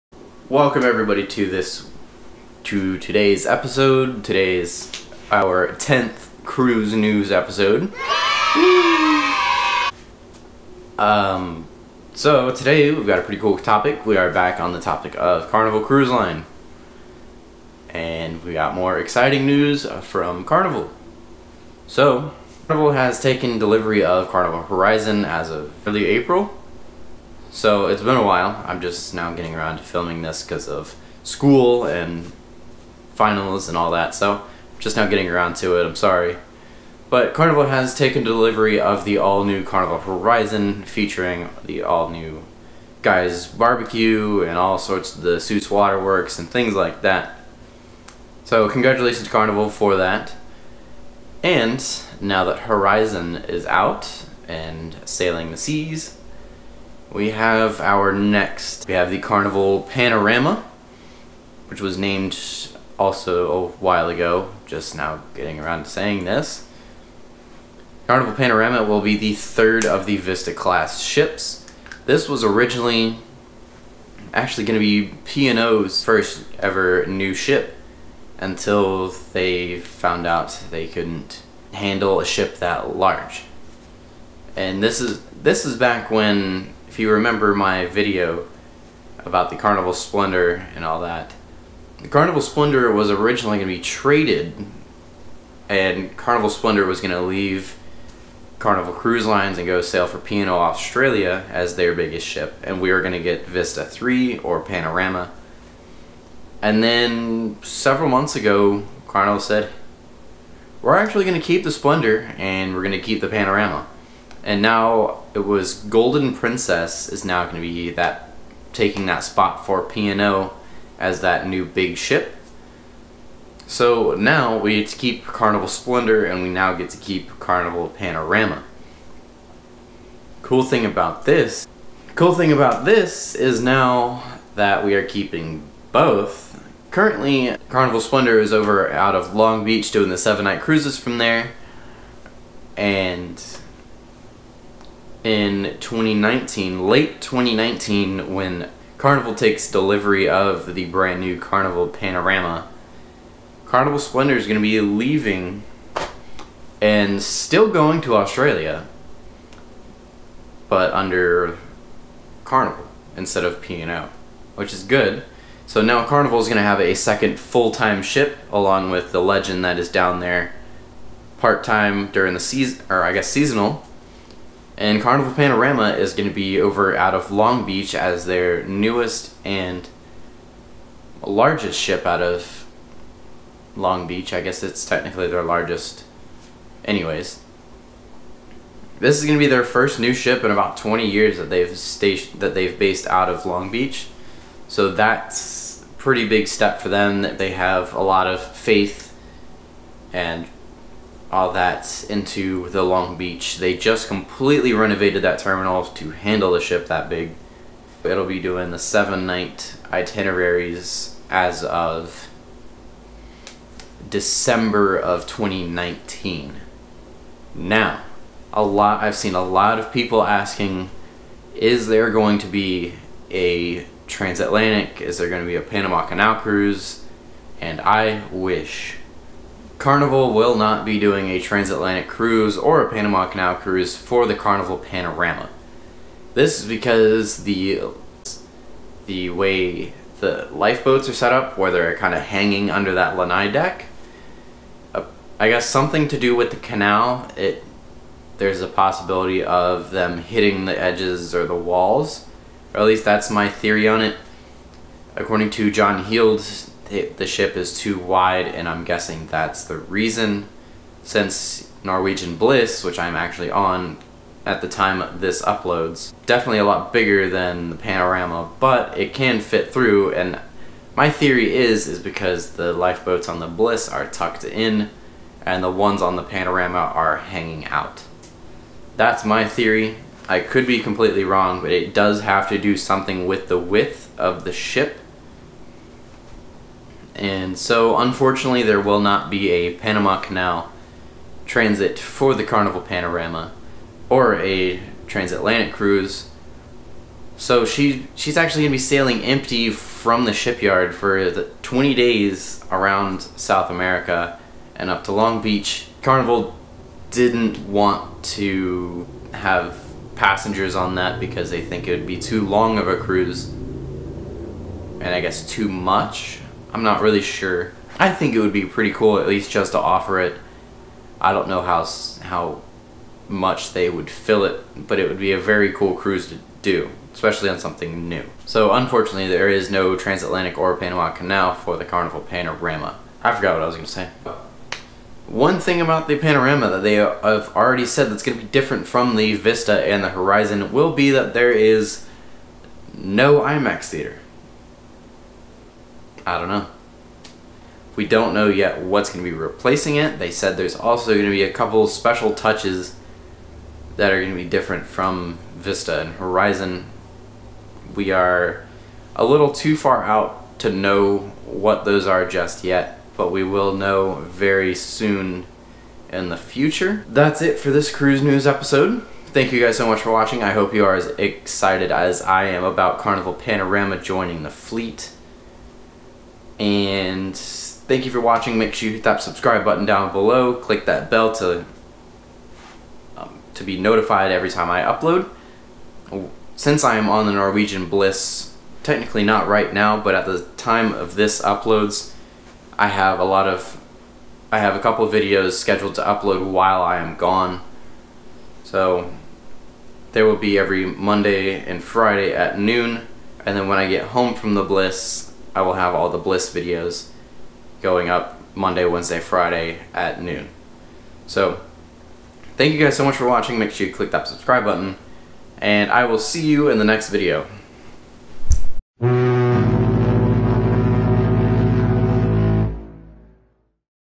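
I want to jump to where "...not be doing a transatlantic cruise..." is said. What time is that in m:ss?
3:50.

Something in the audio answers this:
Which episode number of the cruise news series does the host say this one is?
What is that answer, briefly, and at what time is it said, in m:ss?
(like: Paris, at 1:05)
10th, at 0:05.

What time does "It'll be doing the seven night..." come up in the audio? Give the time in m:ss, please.
3:28.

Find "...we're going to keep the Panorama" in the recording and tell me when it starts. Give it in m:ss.
1:52.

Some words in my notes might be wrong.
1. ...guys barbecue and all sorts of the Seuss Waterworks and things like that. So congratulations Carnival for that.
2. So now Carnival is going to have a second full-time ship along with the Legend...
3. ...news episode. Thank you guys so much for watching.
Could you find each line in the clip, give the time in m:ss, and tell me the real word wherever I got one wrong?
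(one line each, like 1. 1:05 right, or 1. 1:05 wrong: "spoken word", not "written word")
1. 0:43 right
2. 2:45 right
3. 6:08 right.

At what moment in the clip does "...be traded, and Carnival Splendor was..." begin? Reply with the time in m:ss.
1:33.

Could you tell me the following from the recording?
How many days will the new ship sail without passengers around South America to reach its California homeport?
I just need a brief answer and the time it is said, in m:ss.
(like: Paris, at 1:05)
20, at 5:01.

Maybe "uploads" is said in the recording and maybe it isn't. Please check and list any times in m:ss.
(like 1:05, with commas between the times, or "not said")
4:25, 6:24, 6:31, 6:36.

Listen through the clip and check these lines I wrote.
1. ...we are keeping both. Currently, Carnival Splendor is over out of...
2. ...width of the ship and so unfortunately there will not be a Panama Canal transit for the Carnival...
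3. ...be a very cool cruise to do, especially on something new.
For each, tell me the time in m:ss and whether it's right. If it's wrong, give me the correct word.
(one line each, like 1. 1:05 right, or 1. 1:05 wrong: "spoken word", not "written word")
1. 2:14 right
2. 4:43 right
3. 5:25 right.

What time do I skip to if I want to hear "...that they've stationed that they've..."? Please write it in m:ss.
3:11.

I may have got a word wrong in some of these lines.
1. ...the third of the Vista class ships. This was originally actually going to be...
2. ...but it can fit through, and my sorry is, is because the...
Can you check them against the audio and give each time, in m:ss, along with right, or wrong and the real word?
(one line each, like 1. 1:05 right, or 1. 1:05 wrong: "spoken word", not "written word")
1. 1:09 right
2. 4:28 wrong: "theory", not "sorry".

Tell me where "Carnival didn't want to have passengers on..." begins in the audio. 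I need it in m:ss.
5:06.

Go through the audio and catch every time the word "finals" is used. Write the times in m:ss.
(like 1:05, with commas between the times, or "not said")
0:33.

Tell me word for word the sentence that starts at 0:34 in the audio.
So just now getting around to it.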